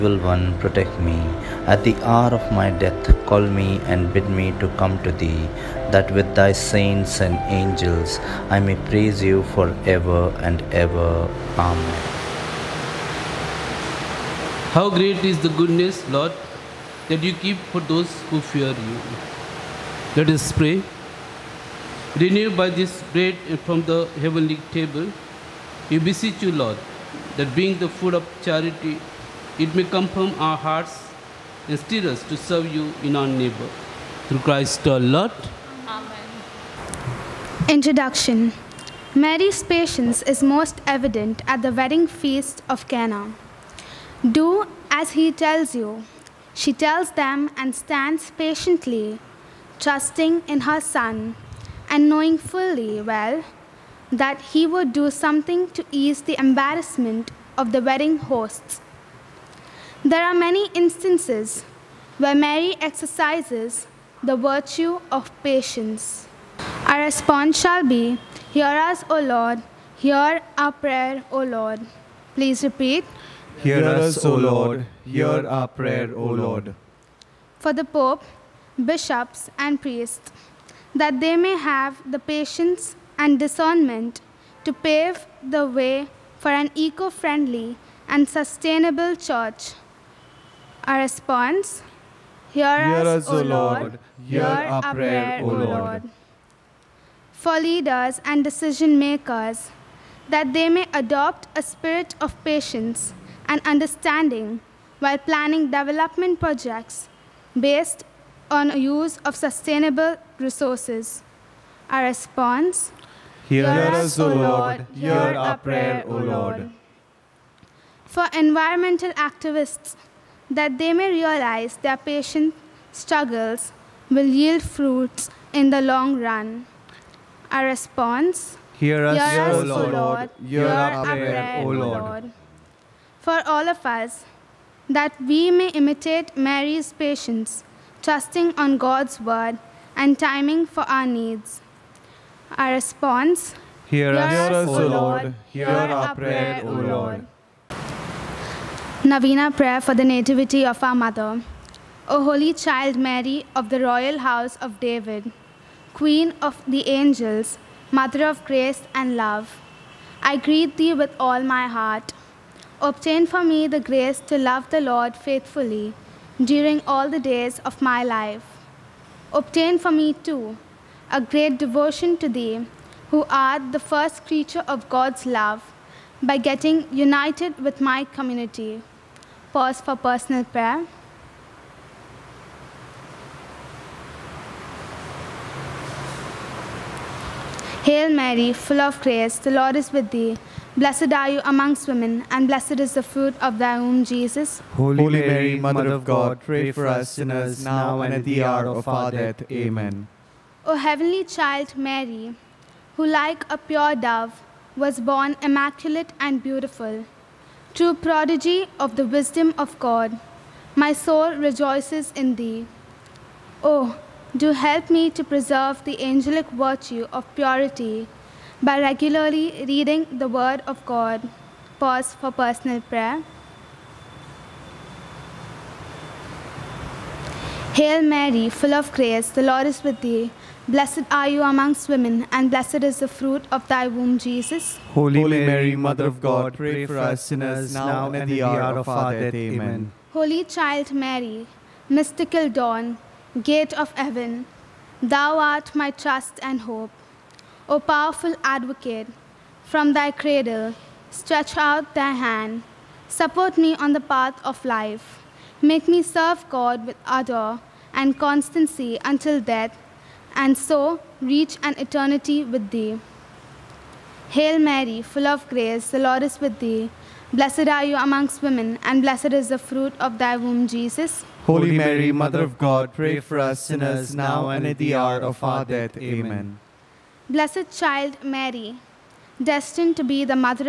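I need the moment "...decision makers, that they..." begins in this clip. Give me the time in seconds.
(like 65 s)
98 s.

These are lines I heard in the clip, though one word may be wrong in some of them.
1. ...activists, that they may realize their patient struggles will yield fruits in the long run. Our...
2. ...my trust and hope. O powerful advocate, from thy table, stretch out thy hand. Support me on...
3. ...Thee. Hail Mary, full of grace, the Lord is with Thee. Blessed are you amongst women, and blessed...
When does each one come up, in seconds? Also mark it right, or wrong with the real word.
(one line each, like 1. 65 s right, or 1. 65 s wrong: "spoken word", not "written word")
1. 119 s right
2. 245 s wrong: "cradle", not "table"
3. 262 s right.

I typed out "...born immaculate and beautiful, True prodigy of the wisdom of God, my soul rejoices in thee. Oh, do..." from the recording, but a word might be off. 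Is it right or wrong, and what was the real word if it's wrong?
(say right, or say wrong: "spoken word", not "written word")
right.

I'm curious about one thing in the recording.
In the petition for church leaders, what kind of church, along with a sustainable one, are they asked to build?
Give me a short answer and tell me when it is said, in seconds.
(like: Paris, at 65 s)
Eco-friendly, at 86 s.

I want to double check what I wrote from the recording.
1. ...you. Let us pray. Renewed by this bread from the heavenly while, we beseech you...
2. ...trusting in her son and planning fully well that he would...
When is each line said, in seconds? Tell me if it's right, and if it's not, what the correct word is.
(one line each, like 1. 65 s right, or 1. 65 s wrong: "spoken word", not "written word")
1. 18 s wrong: "table", not "while"
2. 49 s wrong: "knowing", not "planning".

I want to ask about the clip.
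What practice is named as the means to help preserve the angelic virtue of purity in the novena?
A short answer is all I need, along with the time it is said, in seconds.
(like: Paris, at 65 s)
Regularly reading the Word of God, at 218 s.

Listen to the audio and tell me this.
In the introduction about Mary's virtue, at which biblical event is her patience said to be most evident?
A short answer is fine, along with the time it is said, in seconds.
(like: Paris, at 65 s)
Wedding feast of Cana, at 41 s.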